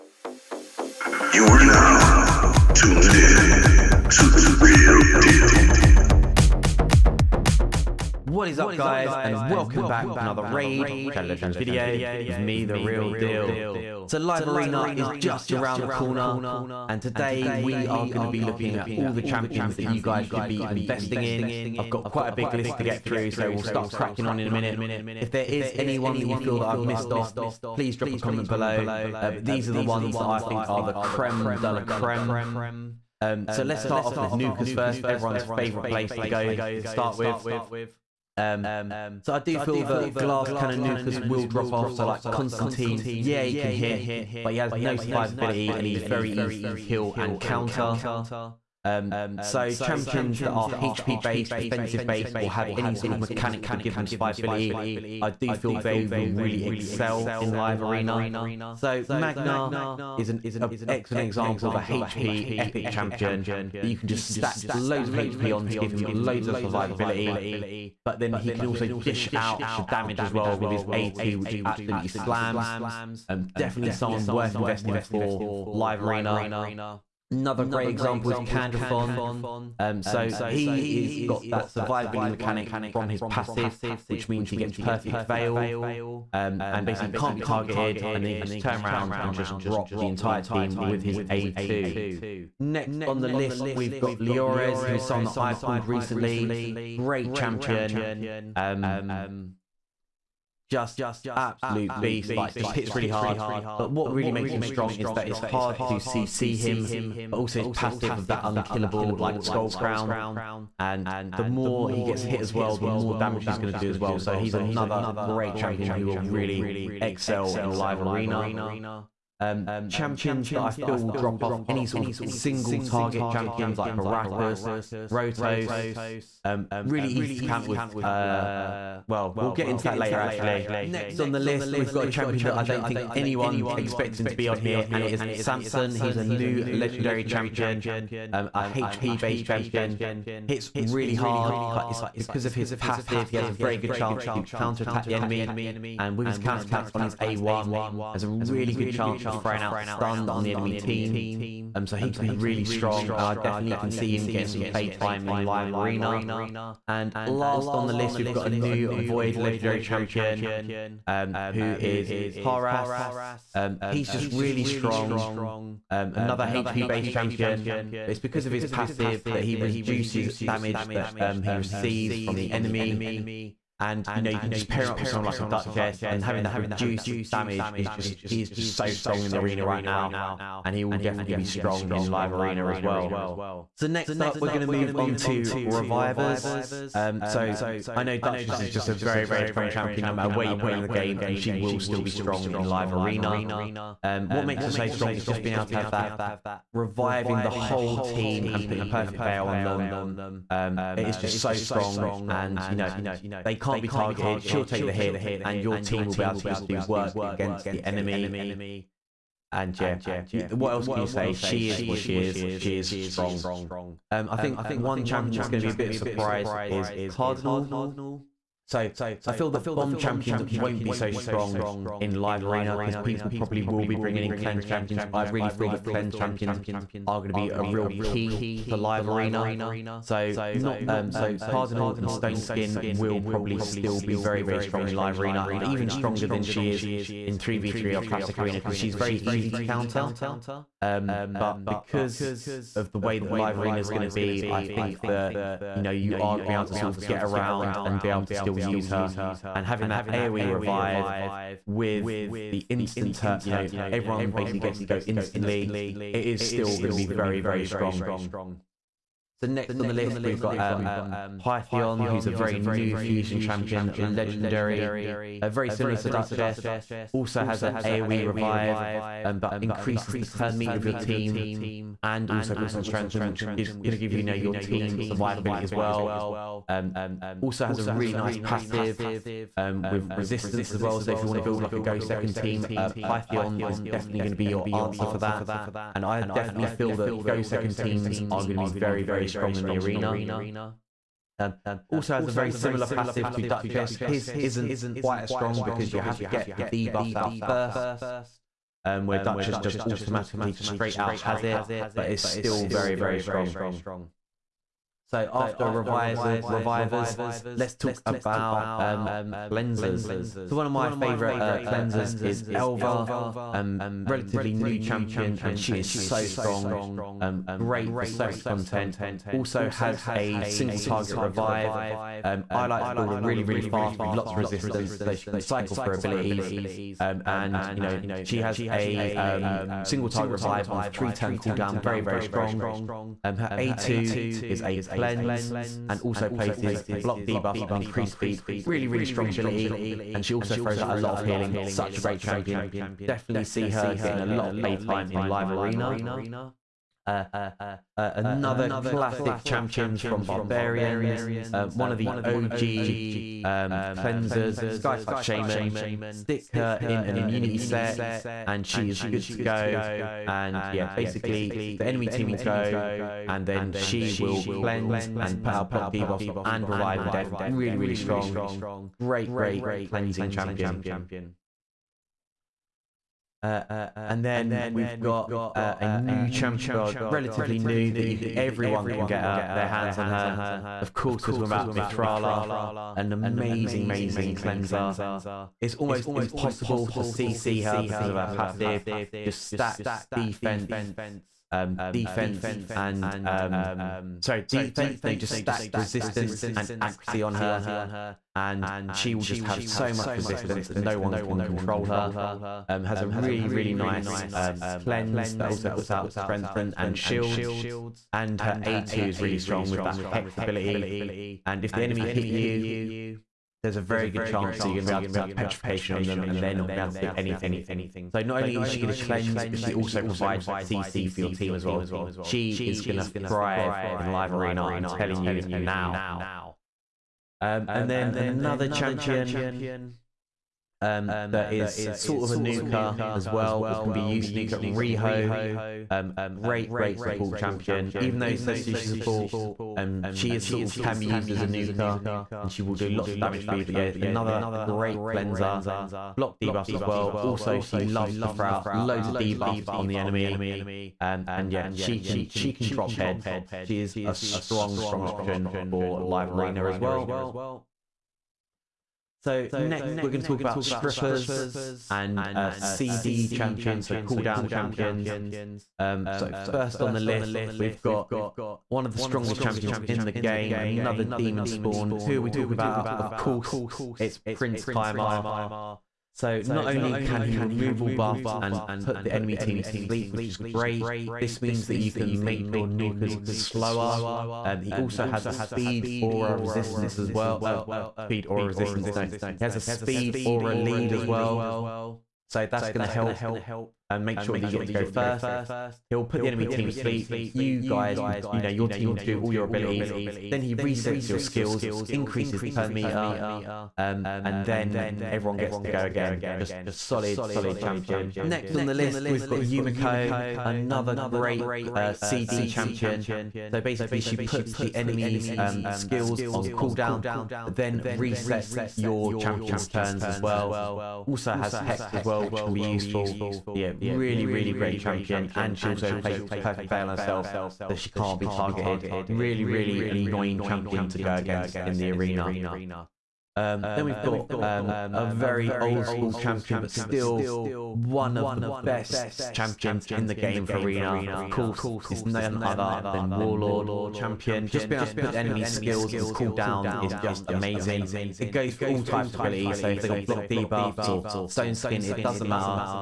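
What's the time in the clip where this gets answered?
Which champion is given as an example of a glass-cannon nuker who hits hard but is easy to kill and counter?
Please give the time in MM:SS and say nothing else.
00:42.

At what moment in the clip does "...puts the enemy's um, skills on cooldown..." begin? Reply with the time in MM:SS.
08:34.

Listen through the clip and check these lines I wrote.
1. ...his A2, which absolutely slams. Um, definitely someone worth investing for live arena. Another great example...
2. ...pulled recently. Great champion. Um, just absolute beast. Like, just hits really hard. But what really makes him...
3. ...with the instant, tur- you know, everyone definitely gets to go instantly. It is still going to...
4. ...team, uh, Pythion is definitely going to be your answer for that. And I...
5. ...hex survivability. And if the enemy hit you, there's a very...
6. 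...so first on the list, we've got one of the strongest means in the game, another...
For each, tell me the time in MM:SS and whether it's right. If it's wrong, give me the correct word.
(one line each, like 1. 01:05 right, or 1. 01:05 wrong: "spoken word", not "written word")
1. 01:10 right
2. 01:35 right
3. 04:11 wrong: "basically", not "definitely"
4. 04:42 right
5. 06:49 wrong: "ability", not "survivability"
6. 07:46 wrong: "champions", not "means".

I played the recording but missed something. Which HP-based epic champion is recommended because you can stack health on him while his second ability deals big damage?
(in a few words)
Magnar.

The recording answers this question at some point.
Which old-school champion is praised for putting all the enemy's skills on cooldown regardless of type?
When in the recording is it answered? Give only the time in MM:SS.
09:03.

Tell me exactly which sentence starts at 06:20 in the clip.
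Of course, we're talking about Mithrala, an amazing, amazing cleanser.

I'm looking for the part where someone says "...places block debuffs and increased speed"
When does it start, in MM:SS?
05:36.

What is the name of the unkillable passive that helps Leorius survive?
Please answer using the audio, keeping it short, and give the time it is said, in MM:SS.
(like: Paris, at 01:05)
Skull Crown, at 01:49.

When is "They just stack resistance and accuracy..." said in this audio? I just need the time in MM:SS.
06:35.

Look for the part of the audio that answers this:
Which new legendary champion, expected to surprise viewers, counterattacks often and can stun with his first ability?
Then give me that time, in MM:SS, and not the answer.
02:15.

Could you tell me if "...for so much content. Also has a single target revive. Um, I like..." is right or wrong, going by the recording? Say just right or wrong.
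right.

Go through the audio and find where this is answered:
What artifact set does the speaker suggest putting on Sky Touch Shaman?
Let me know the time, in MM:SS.
05:57.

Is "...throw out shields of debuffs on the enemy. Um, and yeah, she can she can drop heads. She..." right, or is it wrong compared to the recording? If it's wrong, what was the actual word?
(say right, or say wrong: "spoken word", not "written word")
wrong: "loads", not "shields".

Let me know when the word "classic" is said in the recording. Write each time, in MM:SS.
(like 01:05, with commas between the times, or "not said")
03:58, 05:48.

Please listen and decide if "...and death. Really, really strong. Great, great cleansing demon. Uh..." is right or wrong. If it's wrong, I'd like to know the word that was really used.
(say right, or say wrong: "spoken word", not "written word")
wrong: "champion", not "demon".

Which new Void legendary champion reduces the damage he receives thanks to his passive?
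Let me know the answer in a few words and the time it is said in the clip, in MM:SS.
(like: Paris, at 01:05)
Taras, at 02:42.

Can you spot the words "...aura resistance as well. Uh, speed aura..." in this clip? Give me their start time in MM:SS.
08:06.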